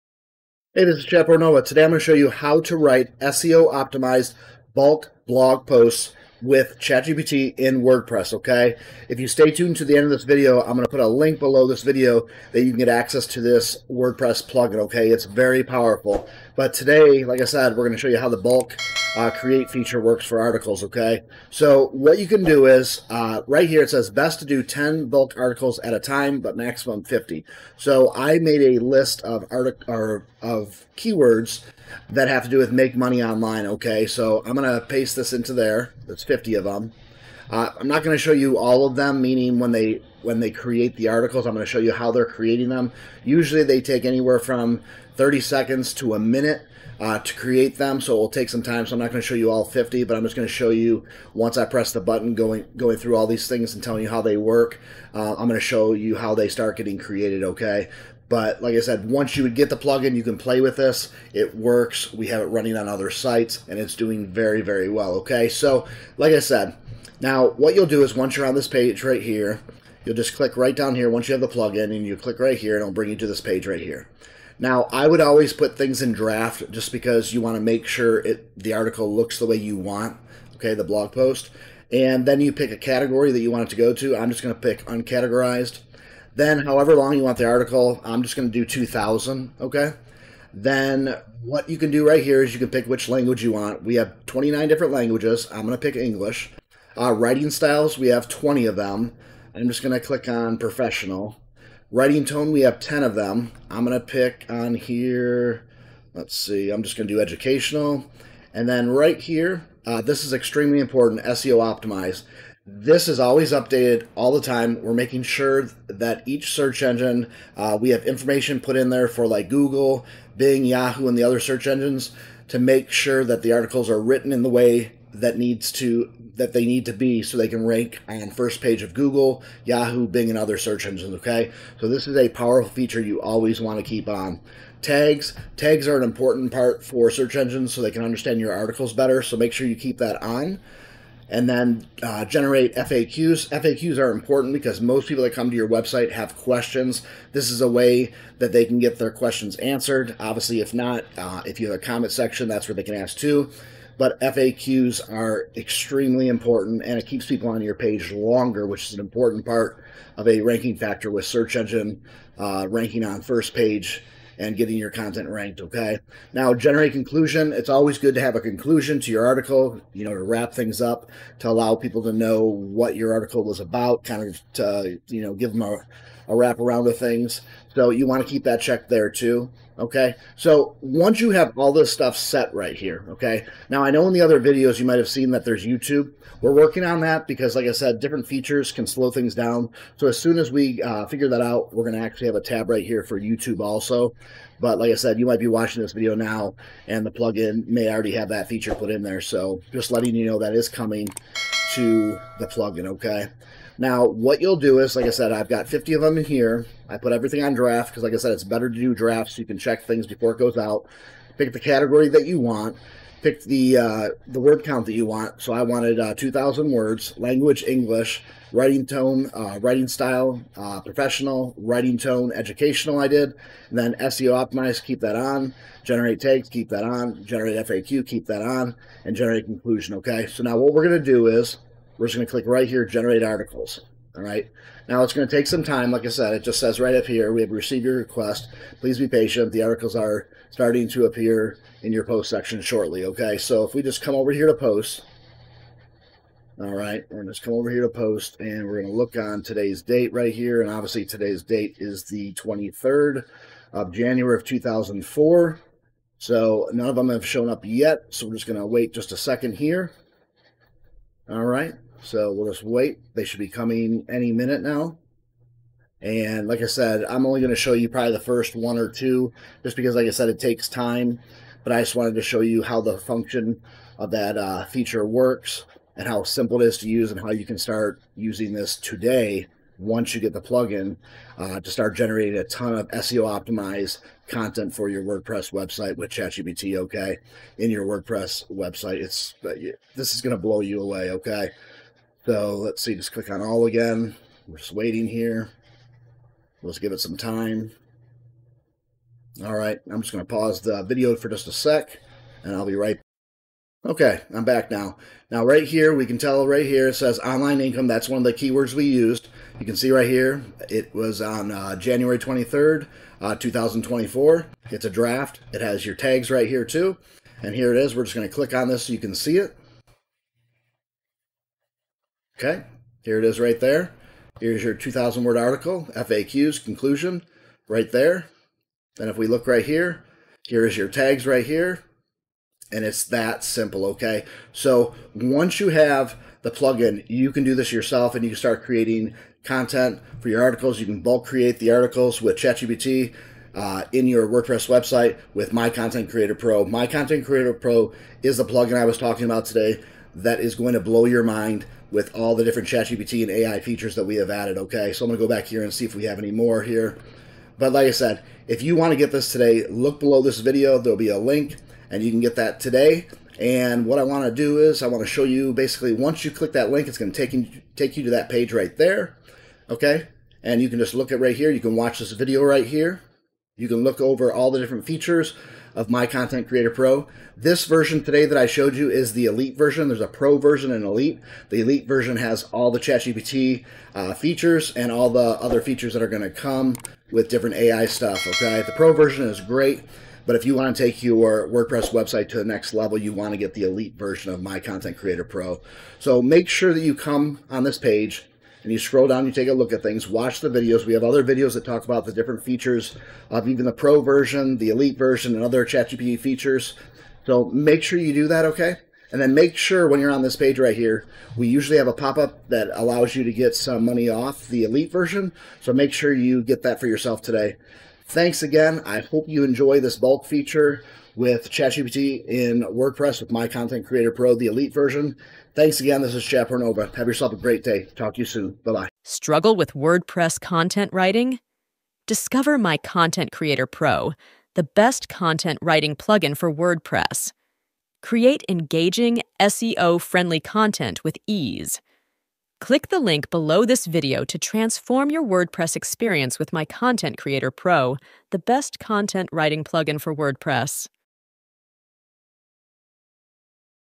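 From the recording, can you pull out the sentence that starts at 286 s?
Okay, in your WordPress website, it's this is going to blow you away.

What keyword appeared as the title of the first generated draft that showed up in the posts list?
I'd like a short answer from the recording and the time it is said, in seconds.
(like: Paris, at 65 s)
online income, at 307 s.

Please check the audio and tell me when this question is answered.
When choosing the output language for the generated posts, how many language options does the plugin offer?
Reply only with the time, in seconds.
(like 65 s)
94 s.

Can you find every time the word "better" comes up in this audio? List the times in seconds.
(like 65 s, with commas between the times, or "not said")
138 s, 208 s.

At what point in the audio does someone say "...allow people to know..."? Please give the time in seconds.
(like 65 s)
171 s.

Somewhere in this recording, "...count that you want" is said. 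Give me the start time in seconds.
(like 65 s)
214 s.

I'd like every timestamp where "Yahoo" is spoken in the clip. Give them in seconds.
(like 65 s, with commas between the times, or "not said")
120 s, 129 s.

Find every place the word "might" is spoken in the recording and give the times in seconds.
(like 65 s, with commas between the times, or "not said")
184 s, 195 s.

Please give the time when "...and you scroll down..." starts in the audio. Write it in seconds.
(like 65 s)
398 s.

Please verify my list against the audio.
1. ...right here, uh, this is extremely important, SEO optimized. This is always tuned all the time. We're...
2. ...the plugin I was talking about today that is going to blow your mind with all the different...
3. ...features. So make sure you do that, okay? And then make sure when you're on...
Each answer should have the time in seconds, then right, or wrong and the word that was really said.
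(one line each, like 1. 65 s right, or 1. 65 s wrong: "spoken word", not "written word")
1. 108 s wrong: "updated", not "tuned"
2. 348 s right
3. 406 s right.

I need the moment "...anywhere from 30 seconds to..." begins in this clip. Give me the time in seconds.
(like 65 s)
44 s.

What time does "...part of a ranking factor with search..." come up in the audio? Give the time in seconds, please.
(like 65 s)
159 s.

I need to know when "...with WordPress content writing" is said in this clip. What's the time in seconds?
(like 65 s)
429 s.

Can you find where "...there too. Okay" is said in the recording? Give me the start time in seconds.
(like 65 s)
178 s.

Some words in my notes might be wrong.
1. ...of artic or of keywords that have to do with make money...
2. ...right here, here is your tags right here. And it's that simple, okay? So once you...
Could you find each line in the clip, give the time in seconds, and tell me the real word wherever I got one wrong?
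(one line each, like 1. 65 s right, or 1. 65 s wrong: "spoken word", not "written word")
1. 29 s right
2. 329 s right.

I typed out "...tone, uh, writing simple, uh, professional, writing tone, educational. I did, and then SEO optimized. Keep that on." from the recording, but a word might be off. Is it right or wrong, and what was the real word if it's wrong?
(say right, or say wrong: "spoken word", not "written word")
wrong: "style", not "simple".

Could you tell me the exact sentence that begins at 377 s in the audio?
This version today that I showed you is the Elite version.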